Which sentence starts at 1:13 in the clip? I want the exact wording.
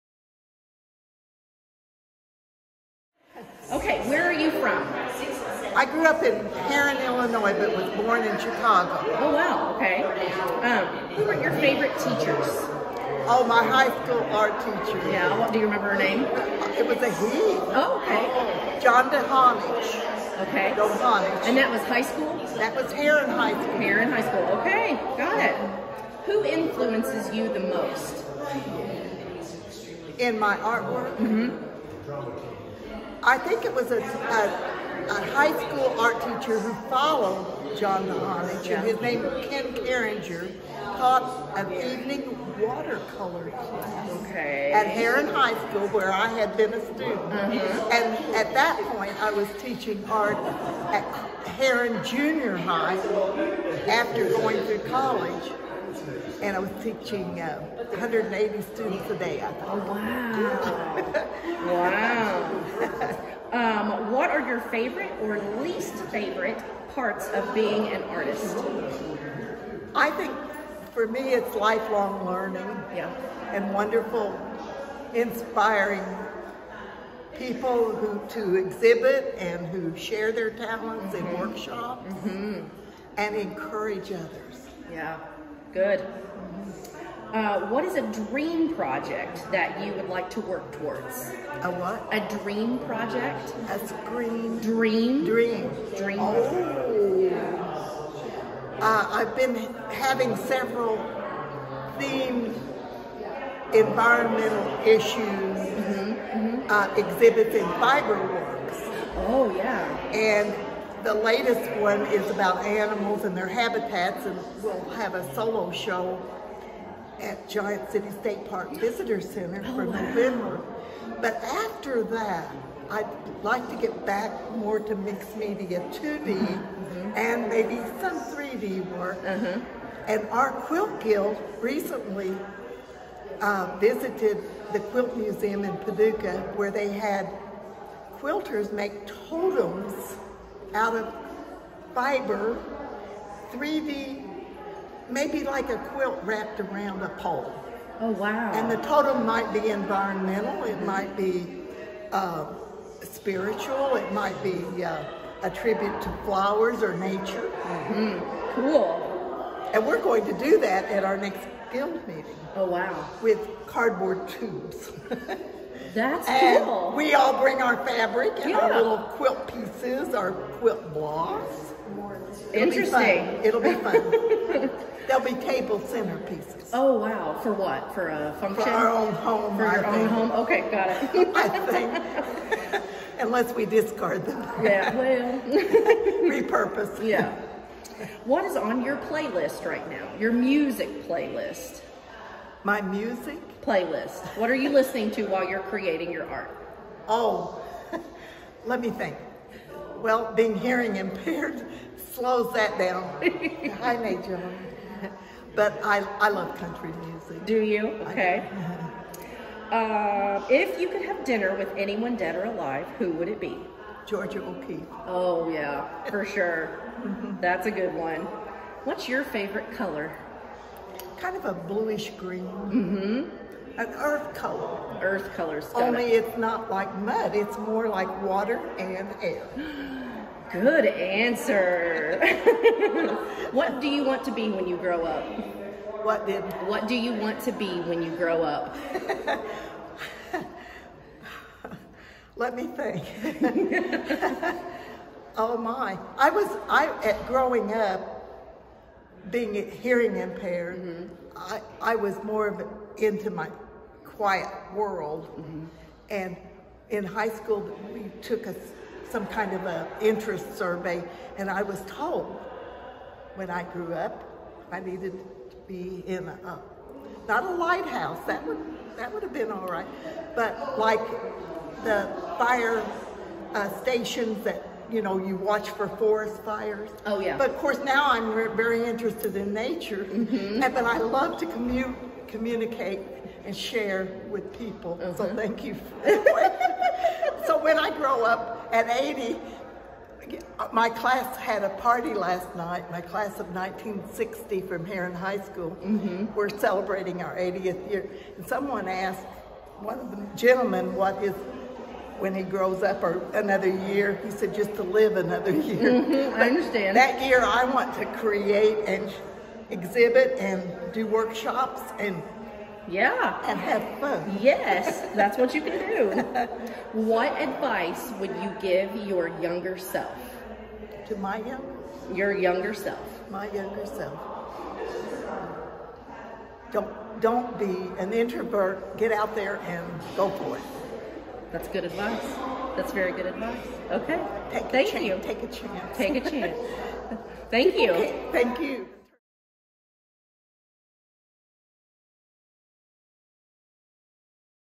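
and wonderful, inspiring people who to exhibit and who share their talents mm -hmm.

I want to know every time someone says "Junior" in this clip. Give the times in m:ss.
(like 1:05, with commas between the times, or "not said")
0:52.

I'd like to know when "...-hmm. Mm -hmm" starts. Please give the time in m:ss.
1:45.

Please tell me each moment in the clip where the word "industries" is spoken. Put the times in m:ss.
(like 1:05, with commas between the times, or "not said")
not said.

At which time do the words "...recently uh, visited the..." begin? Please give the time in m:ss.
2:11.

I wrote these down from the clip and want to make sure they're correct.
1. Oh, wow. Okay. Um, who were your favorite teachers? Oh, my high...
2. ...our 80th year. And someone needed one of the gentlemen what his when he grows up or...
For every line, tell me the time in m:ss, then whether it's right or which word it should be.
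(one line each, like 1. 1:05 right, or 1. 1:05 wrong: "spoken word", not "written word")
1. 0:09 right
2. 4:57 wrong: "asked", not "needed".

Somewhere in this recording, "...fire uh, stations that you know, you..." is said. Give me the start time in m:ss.
4:32.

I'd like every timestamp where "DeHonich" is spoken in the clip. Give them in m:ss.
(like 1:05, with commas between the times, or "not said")
0:19.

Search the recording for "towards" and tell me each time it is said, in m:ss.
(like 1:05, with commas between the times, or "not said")
1:30.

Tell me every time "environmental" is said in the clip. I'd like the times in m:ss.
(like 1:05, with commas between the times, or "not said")
1:43, 2:29.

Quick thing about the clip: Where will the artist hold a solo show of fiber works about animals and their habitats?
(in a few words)
Giant City State Park Visitor Center.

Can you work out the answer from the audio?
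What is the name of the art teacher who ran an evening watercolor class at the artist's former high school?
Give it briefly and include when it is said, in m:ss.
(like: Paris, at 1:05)
Ken Carringer, at 0:39.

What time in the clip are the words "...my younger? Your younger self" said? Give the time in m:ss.
5:21.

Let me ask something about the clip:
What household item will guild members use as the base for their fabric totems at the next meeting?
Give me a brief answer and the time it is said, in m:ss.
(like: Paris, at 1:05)
Cardboard tubes, at 2:43.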